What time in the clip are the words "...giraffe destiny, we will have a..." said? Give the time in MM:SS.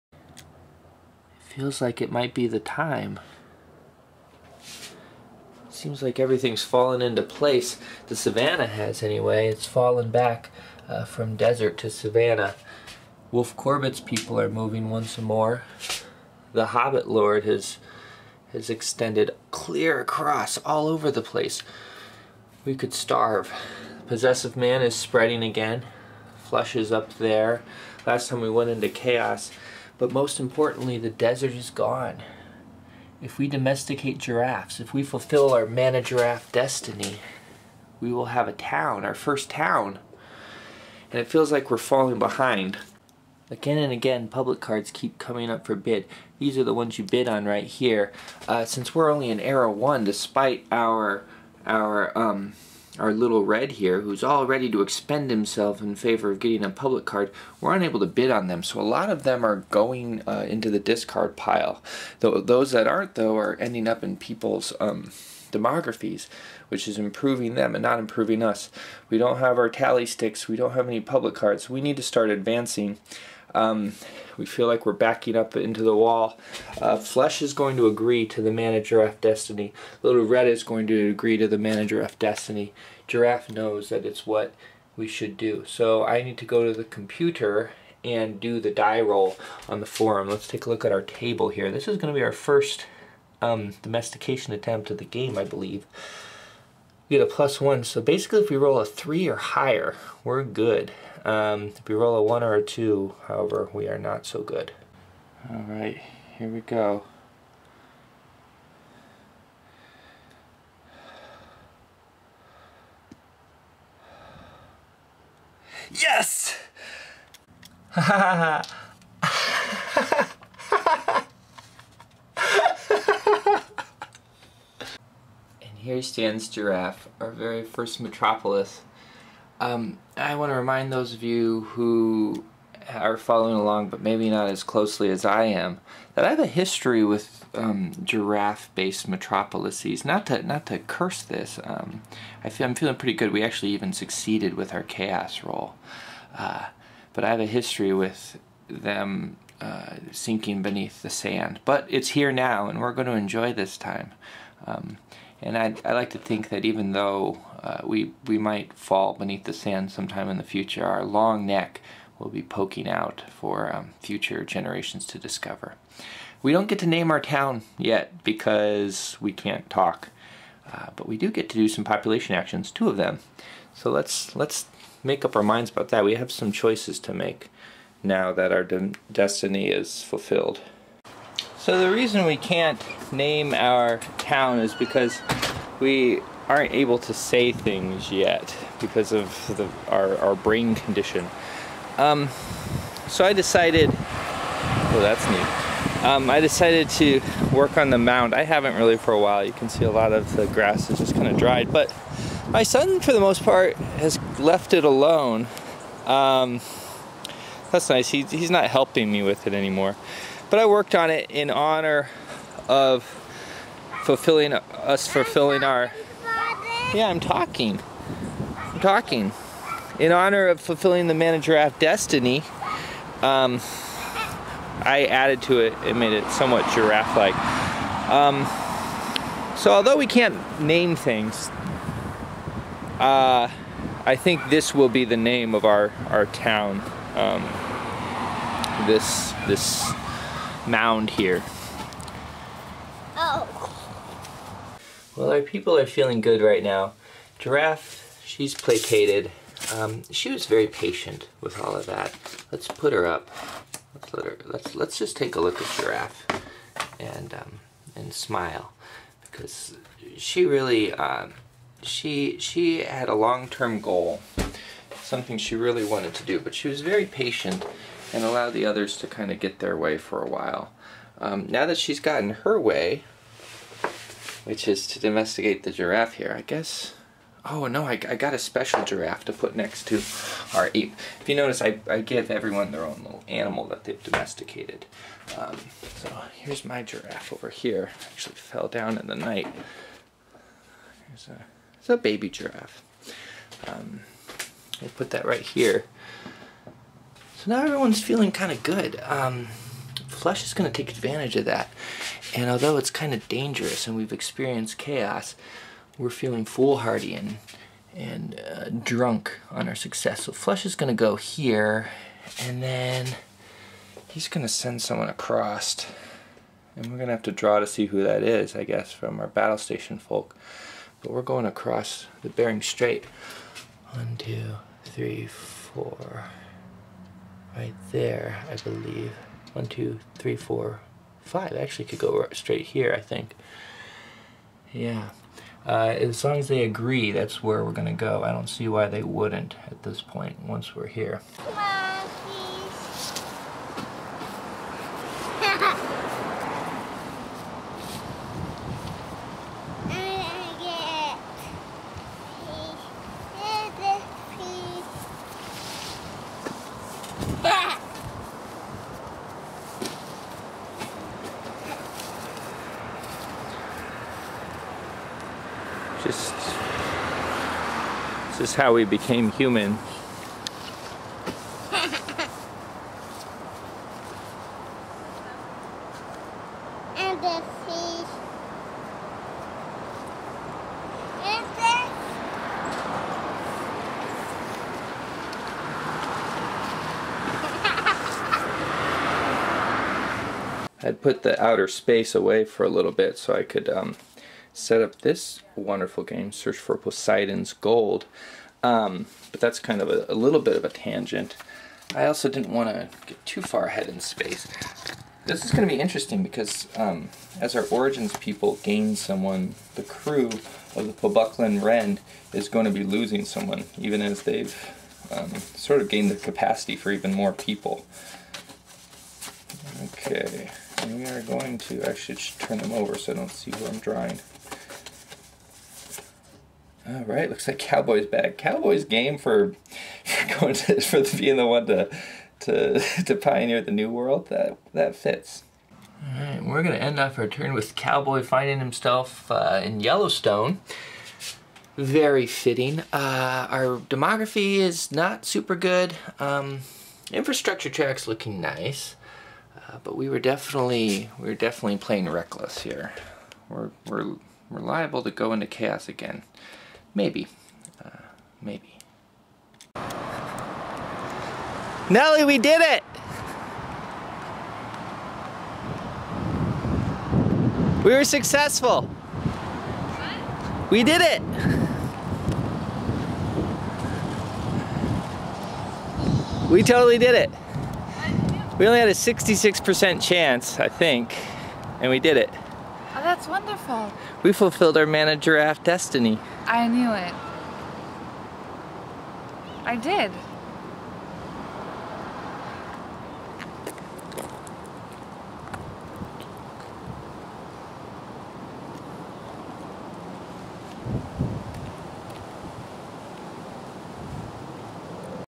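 00:36.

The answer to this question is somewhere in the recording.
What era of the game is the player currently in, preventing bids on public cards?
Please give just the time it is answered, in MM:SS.
00:49.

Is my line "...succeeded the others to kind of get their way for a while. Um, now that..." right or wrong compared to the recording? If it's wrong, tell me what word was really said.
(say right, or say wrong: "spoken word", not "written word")
wrong: "allowed", not "succeeded".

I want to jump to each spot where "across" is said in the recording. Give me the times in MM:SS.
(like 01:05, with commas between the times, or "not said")
00:19, 05:15, 05:21.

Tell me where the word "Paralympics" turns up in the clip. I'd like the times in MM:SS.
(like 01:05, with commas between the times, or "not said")
not said.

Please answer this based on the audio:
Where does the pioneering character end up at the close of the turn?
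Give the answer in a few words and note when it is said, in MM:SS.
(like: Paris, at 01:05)
Yellowstone, at 07:19.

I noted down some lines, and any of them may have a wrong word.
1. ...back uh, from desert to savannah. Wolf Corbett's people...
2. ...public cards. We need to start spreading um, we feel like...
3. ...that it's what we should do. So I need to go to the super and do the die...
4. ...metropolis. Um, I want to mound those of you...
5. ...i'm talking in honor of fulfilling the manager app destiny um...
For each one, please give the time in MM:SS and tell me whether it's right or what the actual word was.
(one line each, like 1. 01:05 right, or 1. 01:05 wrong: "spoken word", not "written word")
1. 00:10 right
2. 01:11 wrong: "advancing", not "spreading"
3. 01:23 wrong: "computer", not "super"
4. 02:07 wrong: "remind", not "mound"
5. 03:38 right.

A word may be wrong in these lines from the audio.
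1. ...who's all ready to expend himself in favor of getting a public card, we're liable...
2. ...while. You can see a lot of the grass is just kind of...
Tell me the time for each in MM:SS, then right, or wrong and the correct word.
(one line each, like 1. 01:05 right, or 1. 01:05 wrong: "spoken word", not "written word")
1. 00:54 wrong: "unable", not "liable"
2. 03:19 right.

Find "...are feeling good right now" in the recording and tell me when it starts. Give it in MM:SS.
04:05.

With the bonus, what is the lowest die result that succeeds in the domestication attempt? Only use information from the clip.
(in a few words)
3.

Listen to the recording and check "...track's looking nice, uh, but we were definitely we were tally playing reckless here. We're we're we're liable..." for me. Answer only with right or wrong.
wrong.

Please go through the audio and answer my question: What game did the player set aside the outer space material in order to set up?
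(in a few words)
Search for Poseidon's Gold.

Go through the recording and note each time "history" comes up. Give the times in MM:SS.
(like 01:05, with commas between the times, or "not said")
02:16, 02:27.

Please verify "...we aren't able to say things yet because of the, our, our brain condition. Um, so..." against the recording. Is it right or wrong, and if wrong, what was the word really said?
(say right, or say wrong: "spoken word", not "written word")
right.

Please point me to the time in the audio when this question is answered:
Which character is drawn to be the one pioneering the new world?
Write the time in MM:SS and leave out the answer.
07:07.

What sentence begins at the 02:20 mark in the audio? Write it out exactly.
Not to not to curse this.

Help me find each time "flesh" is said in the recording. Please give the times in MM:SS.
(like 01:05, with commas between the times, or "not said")
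01:16, 05:00, 05:10.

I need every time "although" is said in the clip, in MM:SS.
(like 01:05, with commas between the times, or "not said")
03:49, 05:02.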